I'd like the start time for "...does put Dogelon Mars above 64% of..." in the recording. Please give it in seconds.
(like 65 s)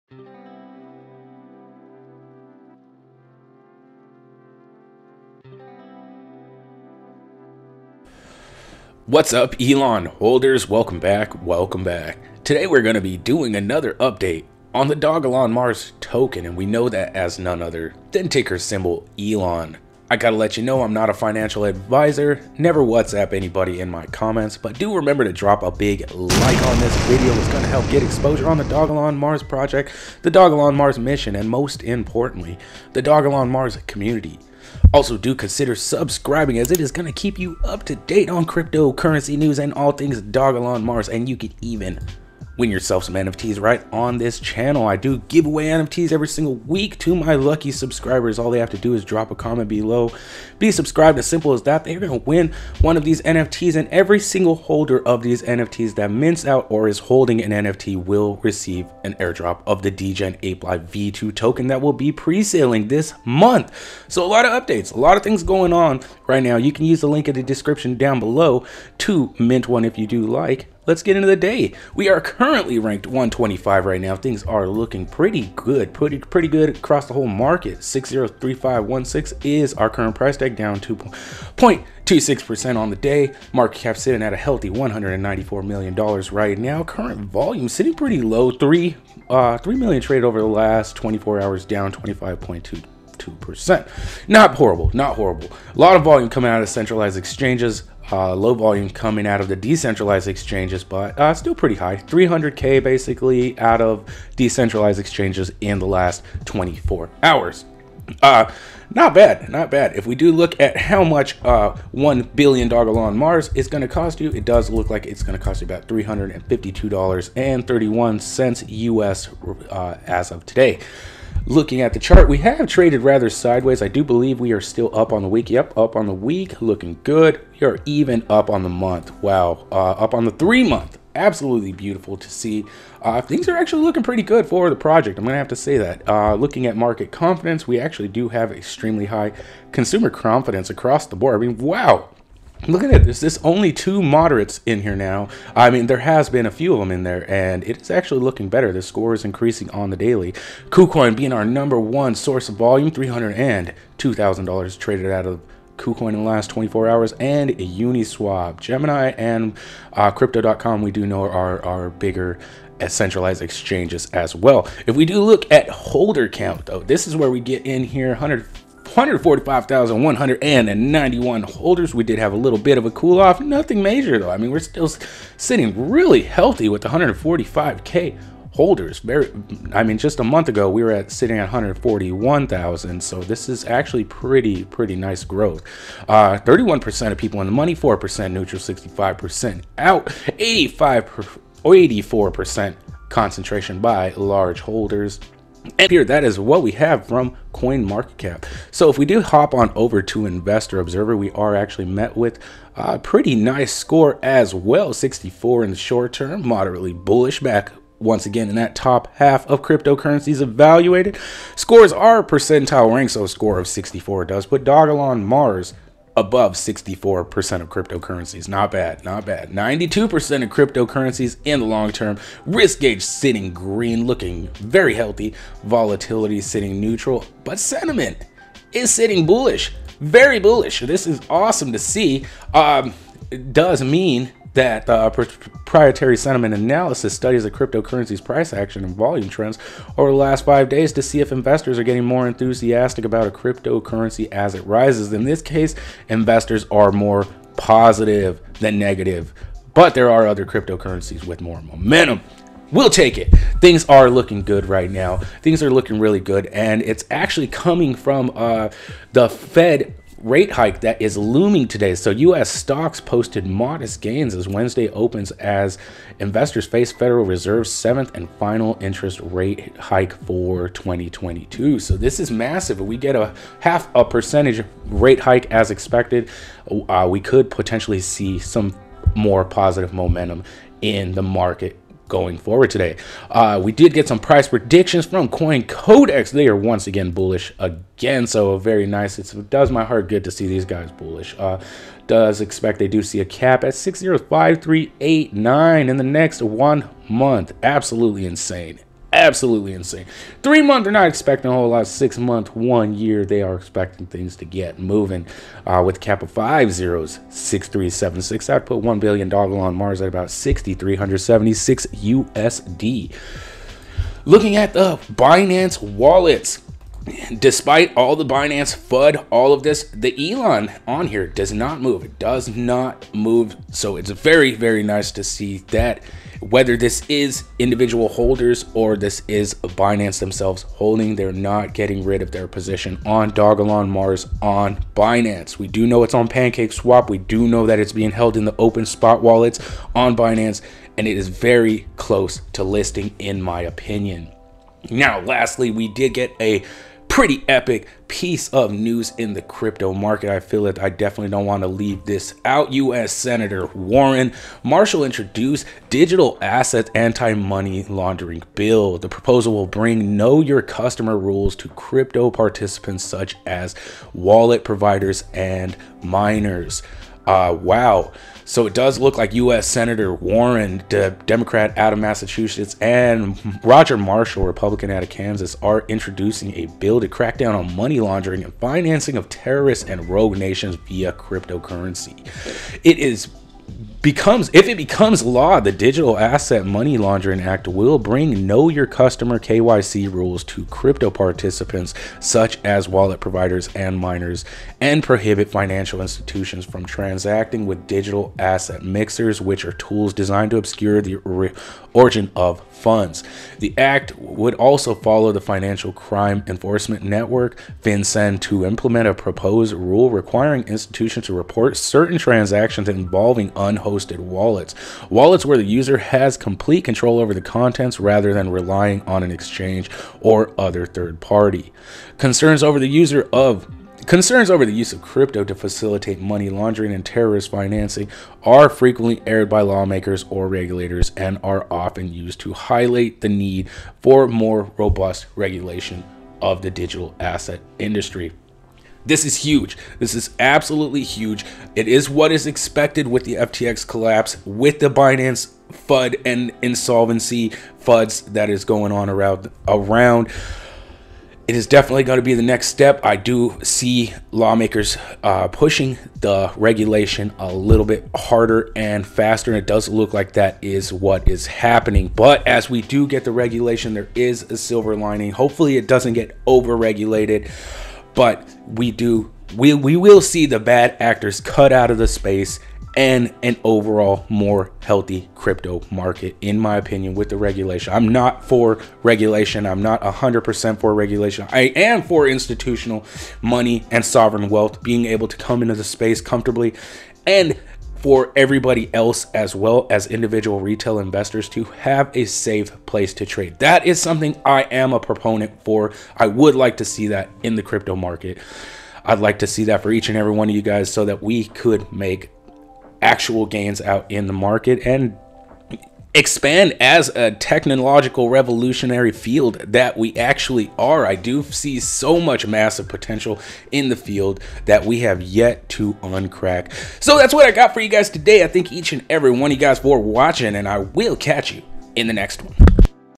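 214 s.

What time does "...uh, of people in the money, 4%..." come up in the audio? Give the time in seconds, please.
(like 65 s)
187 s.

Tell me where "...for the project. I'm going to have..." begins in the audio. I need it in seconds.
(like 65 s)
134 s.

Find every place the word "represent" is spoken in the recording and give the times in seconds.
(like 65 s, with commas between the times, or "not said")
not said.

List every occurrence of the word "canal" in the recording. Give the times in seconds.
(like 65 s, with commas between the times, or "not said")
not said.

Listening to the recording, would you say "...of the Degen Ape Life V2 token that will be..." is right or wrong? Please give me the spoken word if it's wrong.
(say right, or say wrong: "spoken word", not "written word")
right.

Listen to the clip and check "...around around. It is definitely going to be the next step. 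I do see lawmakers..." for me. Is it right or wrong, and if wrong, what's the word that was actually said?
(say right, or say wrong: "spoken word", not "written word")
right.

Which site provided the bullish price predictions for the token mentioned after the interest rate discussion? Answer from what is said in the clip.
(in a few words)
Coin Codex.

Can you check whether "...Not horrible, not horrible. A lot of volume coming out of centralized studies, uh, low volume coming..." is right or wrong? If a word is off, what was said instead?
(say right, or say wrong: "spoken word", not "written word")
wrong: "exchanges", not "studies".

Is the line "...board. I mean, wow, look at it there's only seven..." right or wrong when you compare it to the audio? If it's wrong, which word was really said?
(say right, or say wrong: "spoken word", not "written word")
wrong: "two", not "seven".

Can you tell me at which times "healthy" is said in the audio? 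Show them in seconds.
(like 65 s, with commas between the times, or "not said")
84 s, 176 s, 224 s, 474 s.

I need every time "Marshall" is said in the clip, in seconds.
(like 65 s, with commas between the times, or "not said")
354 s, 373 s.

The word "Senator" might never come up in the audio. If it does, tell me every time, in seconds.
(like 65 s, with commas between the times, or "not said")
353 s, 369 s.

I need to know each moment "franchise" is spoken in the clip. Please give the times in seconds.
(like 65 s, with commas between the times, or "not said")
not said.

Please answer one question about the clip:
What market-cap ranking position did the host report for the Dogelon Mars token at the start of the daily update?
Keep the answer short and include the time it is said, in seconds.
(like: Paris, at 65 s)
125, at 72 s.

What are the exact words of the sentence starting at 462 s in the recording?
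But as we do get the regulation, there is a silver lining.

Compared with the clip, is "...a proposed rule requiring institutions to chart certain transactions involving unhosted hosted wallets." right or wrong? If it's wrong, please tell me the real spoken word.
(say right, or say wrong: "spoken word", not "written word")
wrong: "report", not "chart".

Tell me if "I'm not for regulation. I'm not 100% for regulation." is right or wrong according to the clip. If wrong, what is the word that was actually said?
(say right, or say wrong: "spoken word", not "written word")
right.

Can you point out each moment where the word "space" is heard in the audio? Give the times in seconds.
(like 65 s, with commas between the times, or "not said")
472 s, 485 s.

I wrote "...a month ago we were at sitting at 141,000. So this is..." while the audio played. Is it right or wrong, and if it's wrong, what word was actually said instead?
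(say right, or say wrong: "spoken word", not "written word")
right.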